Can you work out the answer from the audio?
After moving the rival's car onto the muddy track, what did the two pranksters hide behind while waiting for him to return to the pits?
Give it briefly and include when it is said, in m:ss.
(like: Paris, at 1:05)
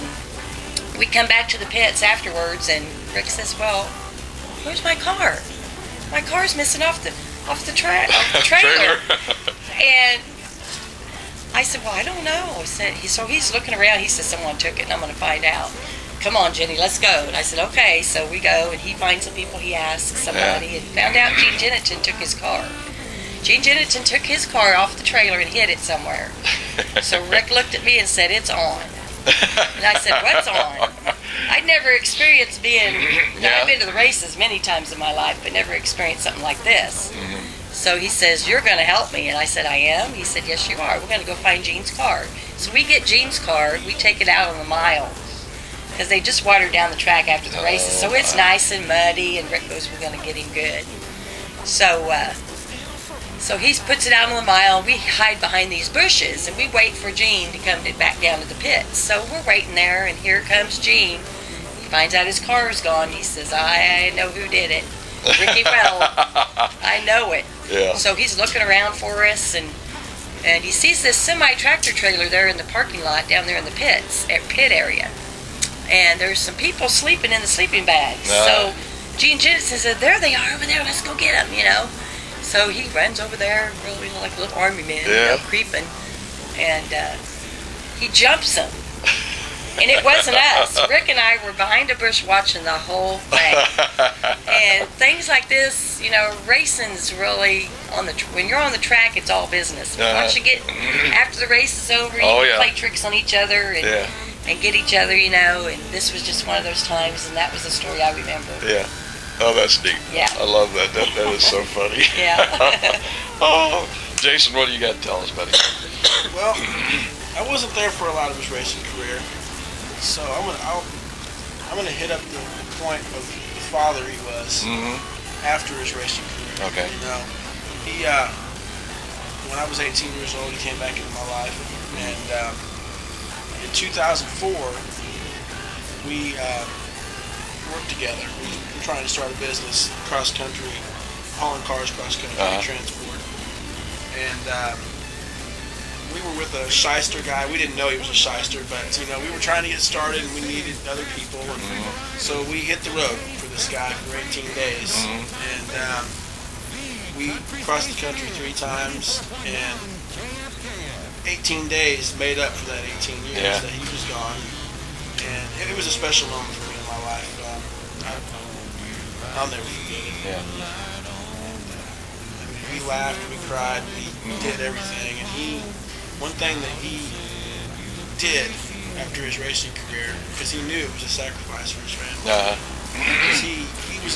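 Bushes, at 0:55.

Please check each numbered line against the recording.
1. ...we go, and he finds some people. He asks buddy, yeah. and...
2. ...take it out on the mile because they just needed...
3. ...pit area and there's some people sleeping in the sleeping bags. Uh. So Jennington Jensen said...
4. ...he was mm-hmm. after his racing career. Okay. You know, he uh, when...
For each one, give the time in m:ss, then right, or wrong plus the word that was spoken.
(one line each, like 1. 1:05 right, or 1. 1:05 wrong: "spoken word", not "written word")
1. 0:18 wrong: "somebody", not "buddy"
2. 0:43 wrong: "watered", not "needed"
3. 1:14 wrong: "Gene", not "Jennington"
4. 2:04 right.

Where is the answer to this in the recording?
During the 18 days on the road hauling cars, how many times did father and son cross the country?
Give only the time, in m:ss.
2:38.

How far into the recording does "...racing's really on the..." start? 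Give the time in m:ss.
1:36.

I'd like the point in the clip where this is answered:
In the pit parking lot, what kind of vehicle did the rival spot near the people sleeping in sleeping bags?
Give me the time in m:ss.
1:11.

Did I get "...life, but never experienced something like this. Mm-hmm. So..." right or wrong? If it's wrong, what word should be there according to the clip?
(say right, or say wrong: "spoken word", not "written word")
right.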